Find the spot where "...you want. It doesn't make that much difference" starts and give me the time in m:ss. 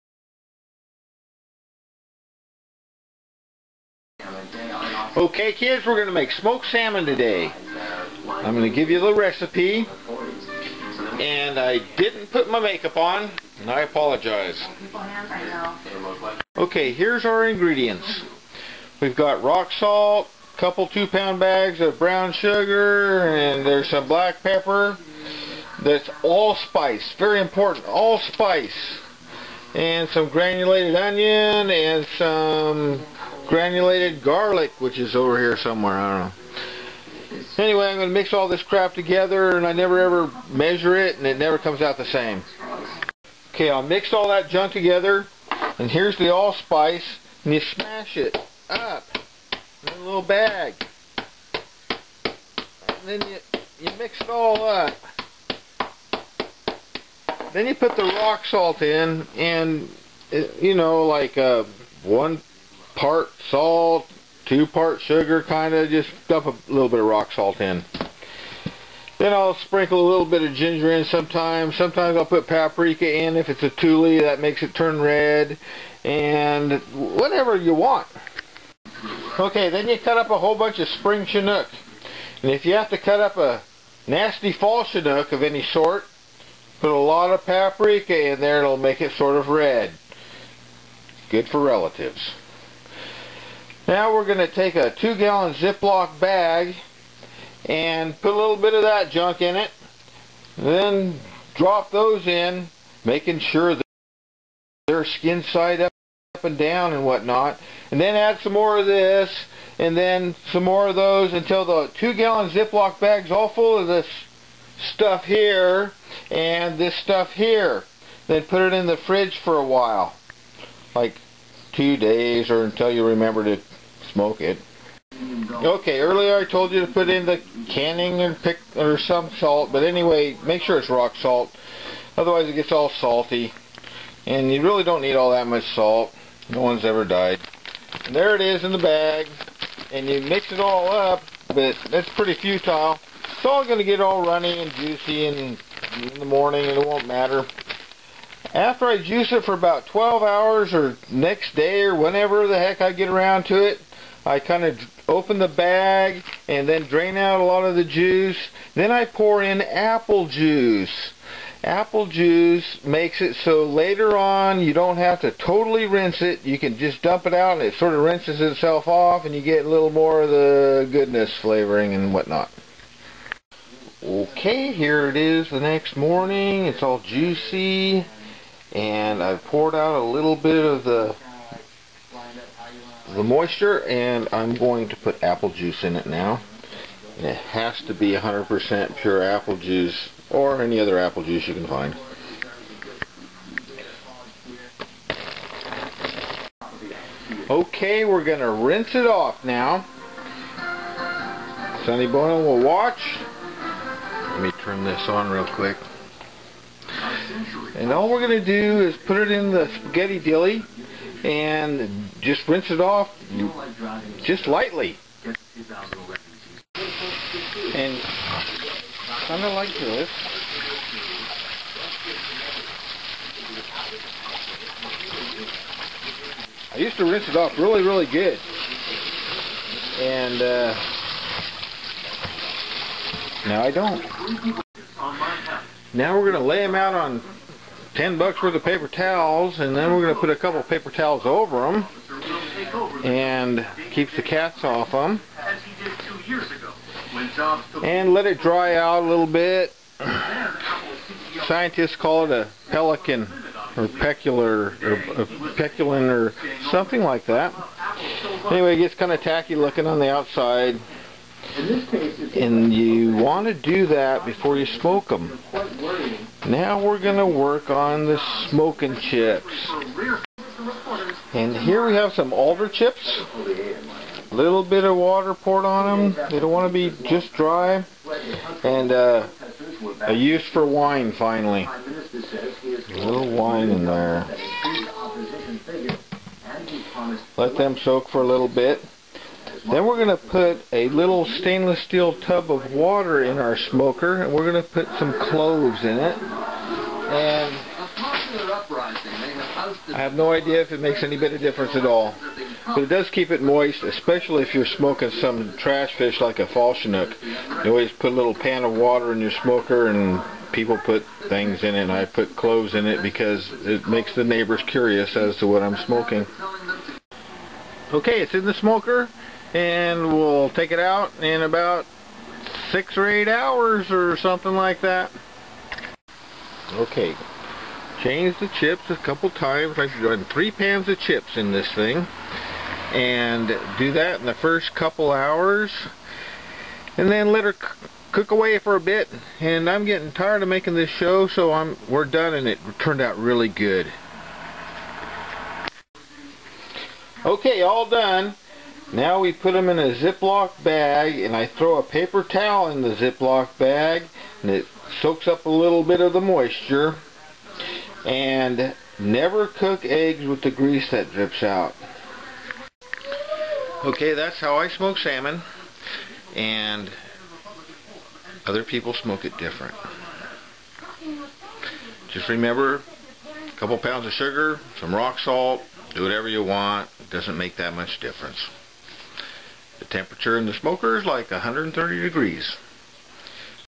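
6:16.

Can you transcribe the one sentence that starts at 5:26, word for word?
Okay, changed the chips a couple times.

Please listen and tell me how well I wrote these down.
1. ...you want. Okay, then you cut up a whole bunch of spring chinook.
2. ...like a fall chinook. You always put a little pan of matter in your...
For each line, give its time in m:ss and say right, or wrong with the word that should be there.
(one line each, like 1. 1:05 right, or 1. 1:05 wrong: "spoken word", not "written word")
1. 1:17 right
2. 5:06 wrong: "water", not "matter".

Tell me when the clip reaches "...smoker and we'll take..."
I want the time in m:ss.
5:18.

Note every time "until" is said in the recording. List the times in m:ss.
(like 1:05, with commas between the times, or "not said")
1:51, 2:02.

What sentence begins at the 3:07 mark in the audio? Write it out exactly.
And it has to be 100% pure apple juice or any other apple juice you can find.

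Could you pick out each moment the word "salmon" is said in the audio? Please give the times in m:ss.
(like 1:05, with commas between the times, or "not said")
0:06, 6:04.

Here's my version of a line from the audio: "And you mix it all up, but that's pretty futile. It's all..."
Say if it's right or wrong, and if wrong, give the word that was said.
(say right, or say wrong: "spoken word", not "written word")
right.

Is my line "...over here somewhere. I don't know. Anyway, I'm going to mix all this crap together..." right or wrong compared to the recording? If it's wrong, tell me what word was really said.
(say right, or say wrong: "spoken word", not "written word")
right.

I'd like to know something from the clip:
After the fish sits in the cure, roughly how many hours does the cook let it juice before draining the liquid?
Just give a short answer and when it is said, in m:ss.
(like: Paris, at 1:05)
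12 hours, at 2:29.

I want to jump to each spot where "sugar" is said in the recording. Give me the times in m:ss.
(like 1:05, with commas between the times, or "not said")
0:22, 1:05, 6:14.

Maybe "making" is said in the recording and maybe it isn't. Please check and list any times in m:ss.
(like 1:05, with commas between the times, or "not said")
1:43, 5:40.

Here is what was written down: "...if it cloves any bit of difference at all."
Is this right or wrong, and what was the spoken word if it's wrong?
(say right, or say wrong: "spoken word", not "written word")
wrong: "makes", not "cloves".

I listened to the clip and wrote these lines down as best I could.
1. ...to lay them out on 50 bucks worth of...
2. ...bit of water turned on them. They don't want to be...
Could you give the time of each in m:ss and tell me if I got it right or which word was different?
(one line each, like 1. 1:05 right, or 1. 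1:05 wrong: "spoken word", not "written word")
1. 3:56 wrong: "10", not "50"
2. 4:34 wrong: "poured", not "turned".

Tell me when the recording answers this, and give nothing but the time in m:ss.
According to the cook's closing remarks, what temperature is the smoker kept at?
6:21.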